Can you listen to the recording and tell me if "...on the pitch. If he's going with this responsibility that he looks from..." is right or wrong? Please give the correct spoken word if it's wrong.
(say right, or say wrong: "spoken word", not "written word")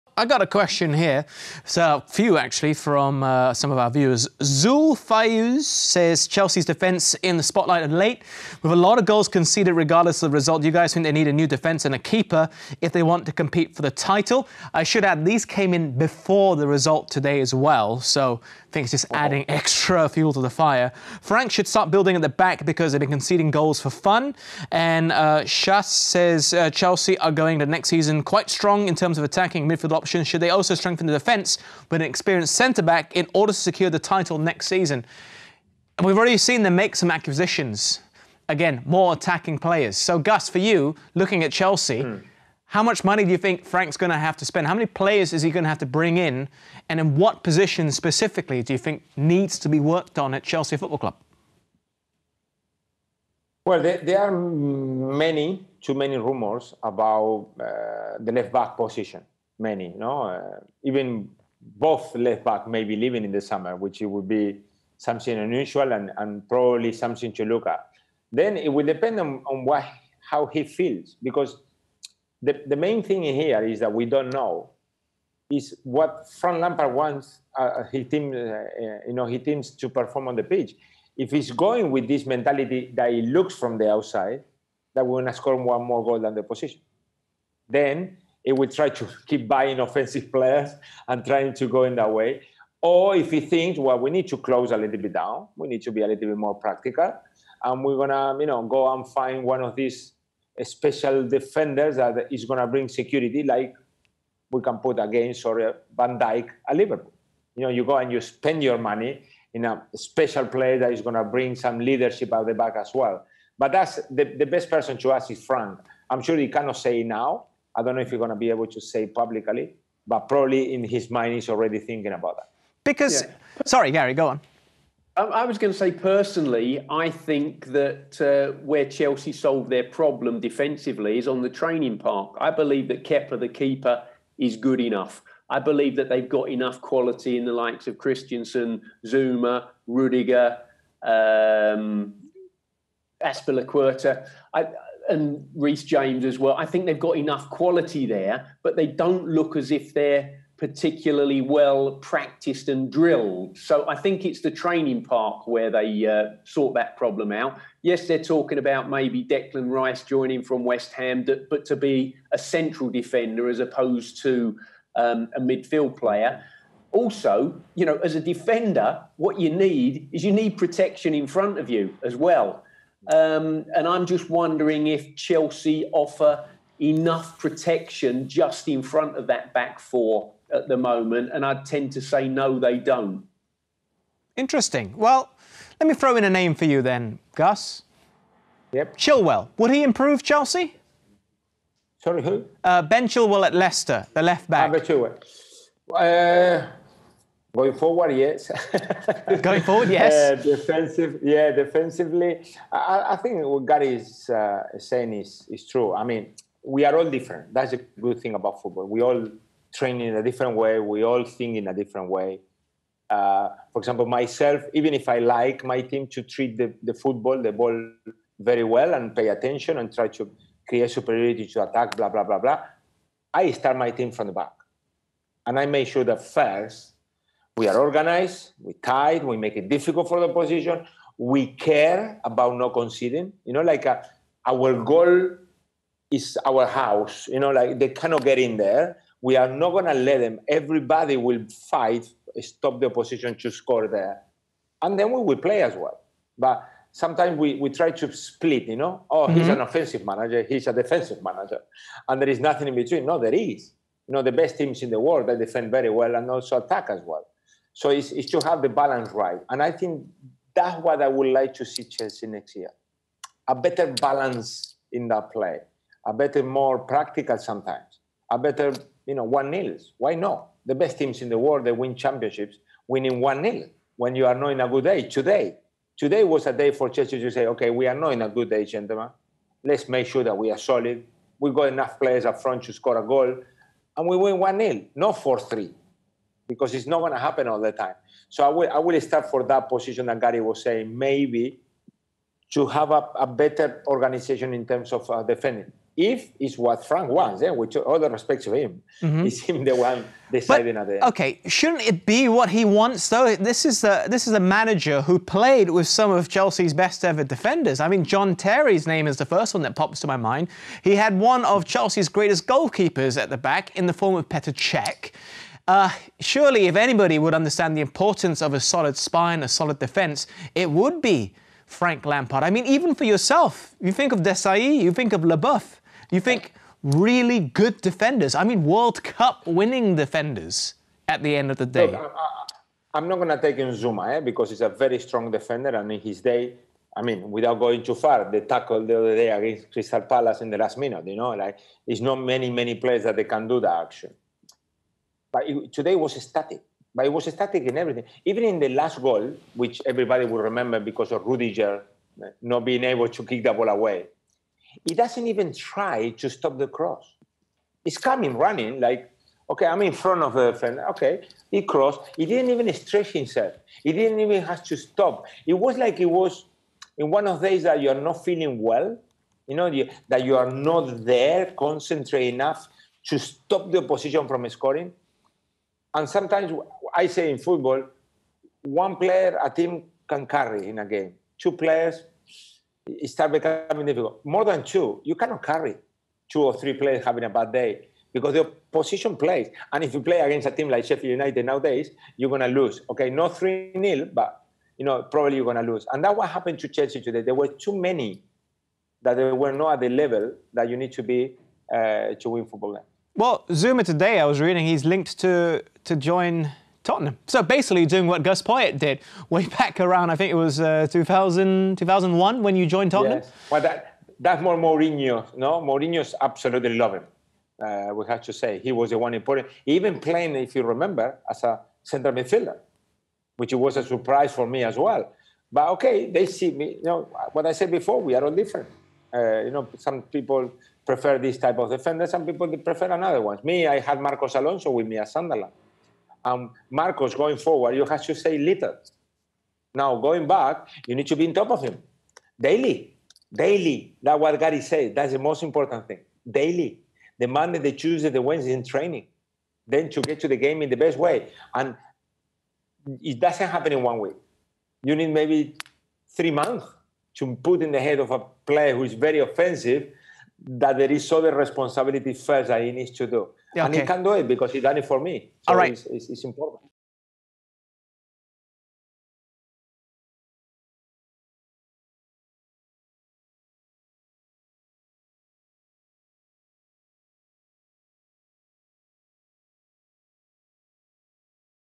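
wrong: "mentality", not "responsibility".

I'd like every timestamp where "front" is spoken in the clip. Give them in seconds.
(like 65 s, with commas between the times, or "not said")
171 s, 178 s, 282 s, 359 s.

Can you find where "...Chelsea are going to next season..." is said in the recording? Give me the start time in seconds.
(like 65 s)
26 s.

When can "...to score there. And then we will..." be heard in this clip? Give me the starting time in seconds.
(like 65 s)
243 s.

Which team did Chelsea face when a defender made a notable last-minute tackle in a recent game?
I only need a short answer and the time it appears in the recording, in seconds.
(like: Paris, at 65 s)
Crystal Palace, at 339 s.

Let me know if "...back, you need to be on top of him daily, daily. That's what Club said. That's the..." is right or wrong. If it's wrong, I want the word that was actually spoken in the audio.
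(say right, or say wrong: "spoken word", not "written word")
wrong: "Gary", not "Club".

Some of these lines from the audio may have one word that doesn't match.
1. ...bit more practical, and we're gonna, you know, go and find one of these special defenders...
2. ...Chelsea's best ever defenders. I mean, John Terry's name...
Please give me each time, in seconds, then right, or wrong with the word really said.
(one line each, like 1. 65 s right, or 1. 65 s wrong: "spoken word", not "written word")
1. 96 s right
2. 306 s right.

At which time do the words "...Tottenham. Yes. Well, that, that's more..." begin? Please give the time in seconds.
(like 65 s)
412 s.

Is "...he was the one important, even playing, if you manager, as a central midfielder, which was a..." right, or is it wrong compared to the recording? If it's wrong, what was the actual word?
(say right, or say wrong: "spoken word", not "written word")
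wrong: "remember", not "manager".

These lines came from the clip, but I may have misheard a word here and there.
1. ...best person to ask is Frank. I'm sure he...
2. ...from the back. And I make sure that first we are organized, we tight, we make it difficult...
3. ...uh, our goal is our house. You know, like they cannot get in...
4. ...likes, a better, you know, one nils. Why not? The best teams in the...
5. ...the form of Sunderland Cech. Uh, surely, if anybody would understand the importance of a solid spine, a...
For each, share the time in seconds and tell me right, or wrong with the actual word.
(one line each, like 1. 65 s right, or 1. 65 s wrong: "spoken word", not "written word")
1. 114 s right
2. 224 s right
3. 233 s right
4. 267 s wrong: "sometimes", not "likes"
5. 313 s wrong: "Petr", not "Sunderland".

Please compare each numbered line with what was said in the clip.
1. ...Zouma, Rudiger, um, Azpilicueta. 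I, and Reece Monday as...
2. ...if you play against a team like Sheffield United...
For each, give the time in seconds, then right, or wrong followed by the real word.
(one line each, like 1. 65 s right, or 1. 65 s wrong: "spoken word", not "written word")
1. 139 s wrong: "James", not "Monday"
2. 389 s right.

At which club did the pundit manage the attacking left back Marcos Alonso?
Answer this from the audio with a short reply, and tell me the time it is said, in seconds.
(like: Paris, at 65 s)
Sunderland, at 435 s.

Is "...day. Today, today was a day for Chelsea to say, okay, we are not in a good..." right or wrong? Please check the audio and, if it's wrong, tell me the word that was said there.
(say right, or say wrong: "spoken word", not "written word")
right.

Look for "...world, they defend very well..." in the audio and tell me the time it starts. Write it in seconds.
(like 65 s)
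254 s.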